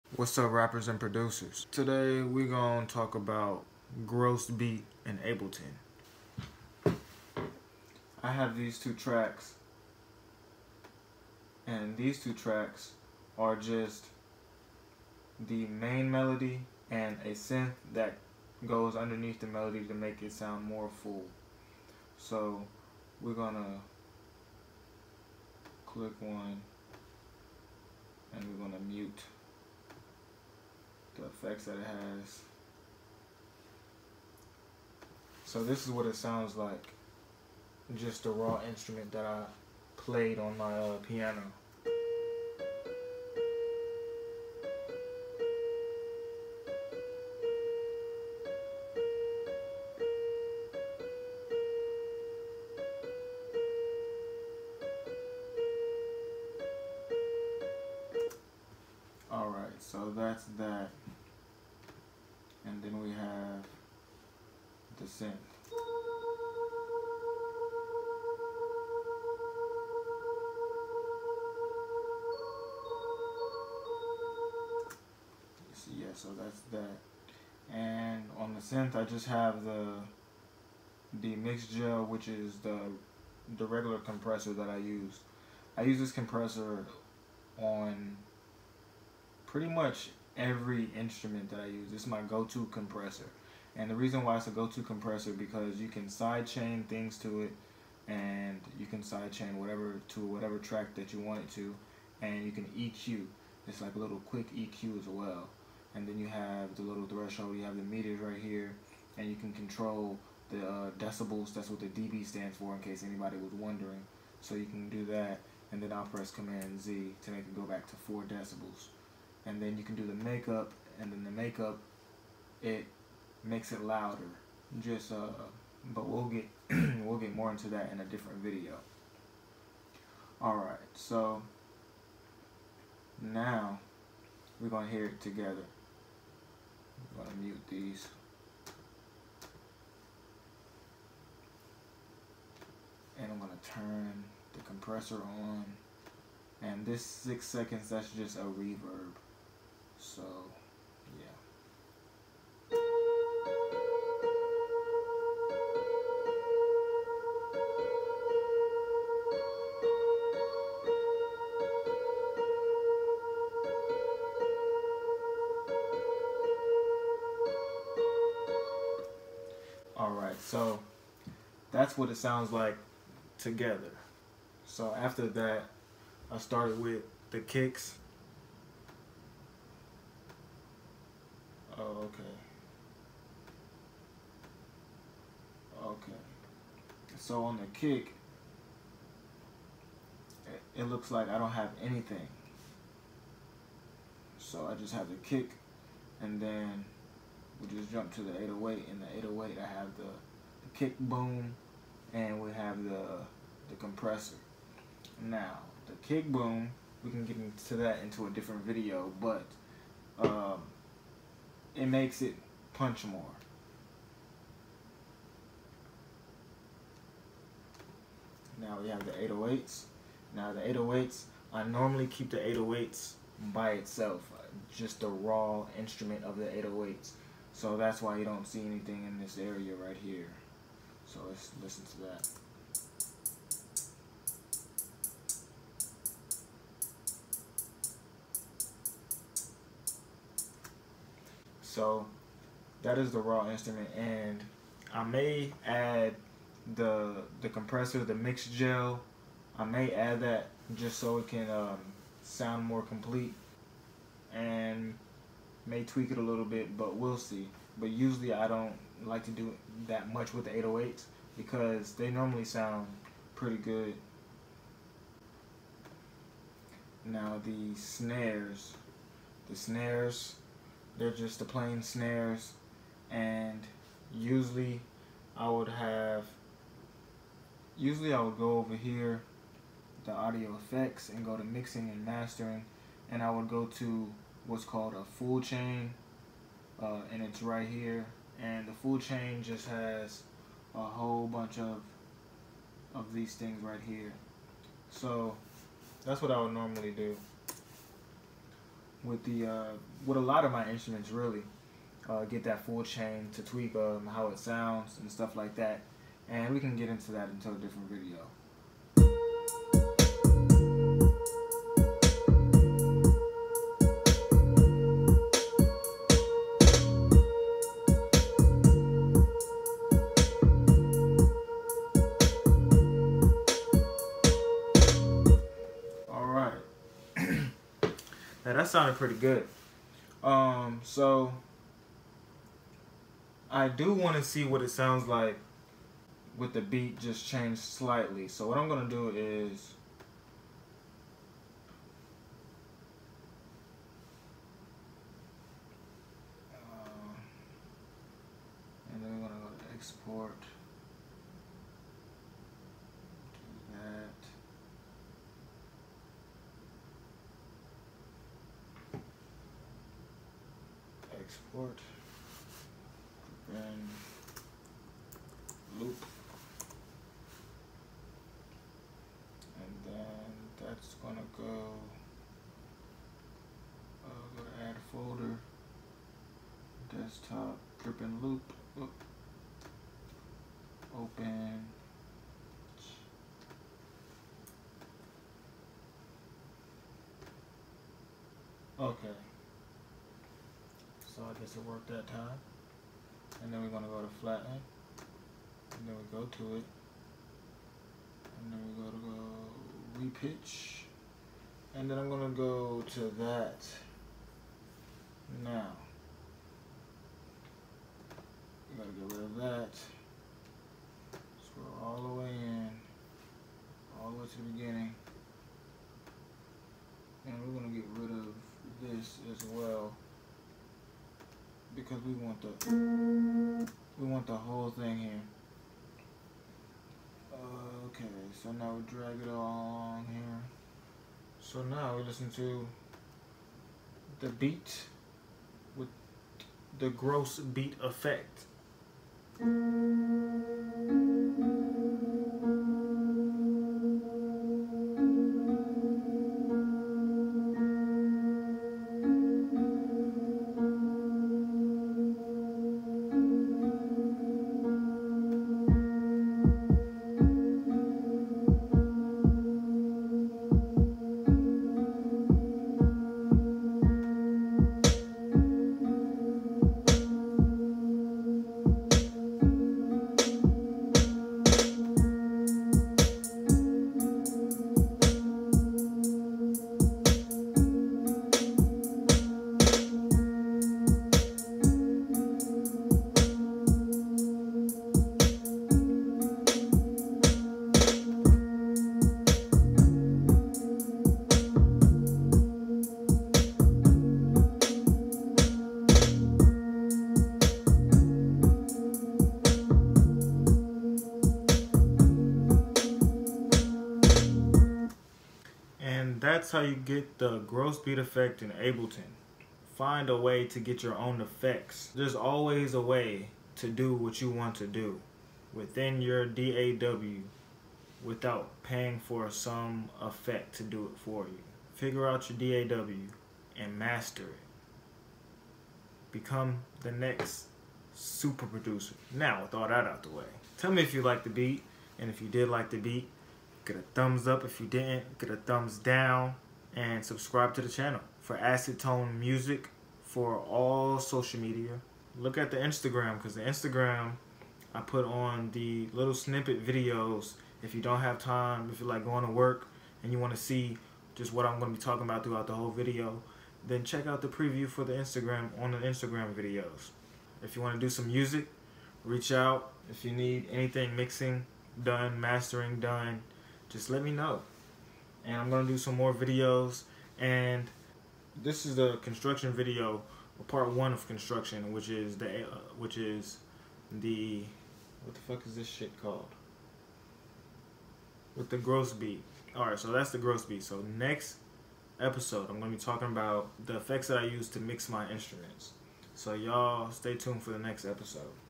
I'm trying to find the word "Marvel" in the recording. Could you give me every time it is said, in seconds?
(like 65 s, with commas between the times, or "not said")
not said.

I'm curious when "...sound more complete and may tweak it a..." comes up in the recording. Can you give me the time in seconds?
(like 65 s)
252 s.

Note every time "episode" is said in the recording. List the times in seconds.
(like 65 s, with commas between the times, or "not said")
581 s, 587 s.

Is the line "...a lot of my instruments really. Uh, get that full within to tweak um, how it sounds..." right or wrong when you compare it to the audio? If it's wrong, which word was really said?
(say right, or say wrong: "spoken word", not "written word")
wrong: "chain", not "within".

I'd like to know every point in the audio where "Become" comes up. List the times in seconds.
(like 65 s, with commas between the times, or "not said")
526 s.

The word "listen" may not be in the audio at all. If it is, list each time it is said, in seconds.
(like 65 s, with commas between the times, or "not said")
231 s, 432 s.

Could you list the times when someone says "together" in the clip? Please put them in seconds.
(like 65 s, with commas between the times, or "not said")
135 s, 173 s.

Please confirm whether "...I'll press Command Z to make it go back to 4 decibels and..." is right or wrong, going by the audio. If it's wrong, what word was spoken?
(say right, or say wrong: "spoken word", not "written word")
right.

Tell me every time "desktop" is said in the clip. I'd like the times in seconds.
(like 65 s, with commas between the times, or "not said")
376 s.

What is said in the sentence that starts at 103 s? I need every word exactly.
It's like a little quick EQ as well.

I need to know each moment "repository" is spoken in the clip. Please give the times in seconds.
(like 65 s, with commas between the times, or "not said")
not said.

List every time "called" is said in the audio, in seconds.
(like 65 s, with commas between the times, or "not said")
284 s, 576 s.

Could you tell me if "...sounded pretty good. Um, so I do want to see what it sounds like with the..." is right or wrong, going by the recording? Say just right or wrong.
right.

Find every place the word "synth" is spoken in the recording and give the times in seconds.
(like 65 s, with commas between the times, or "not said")
17 s, 65 s, 78 s.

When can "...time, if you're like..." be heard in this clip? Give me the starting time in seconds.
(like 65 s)
548 s.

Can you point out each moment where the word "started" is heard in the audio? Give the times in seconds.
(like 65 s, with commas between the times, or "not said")
176 s.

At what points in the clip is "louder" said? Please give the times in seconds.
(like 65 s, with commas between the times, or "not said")
123 s.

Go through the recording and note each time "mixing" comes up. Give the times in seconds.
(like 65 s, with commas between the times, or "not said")
281 s, 560 s.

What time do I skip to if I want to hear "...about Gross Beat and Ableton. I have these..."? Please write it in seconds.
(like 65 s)
3 s.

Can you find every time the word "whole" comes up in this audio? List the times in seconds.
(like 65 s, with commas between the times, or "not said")
290 s, 424 s, 552 s.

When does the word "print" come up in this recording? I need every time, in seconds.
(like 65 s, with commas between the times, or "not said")
not said.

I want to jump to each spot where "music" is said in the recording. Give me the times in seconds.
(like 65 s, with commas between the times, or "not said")
539 s, 558 s.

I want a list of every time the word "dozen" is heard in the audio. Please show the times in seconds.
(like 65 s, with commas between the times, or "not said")
not said.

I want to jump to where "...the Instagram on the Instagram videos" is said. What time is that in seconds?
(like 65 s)
554 s.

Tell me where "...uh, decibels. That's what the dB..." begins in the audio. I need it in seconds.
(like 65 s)
110 s.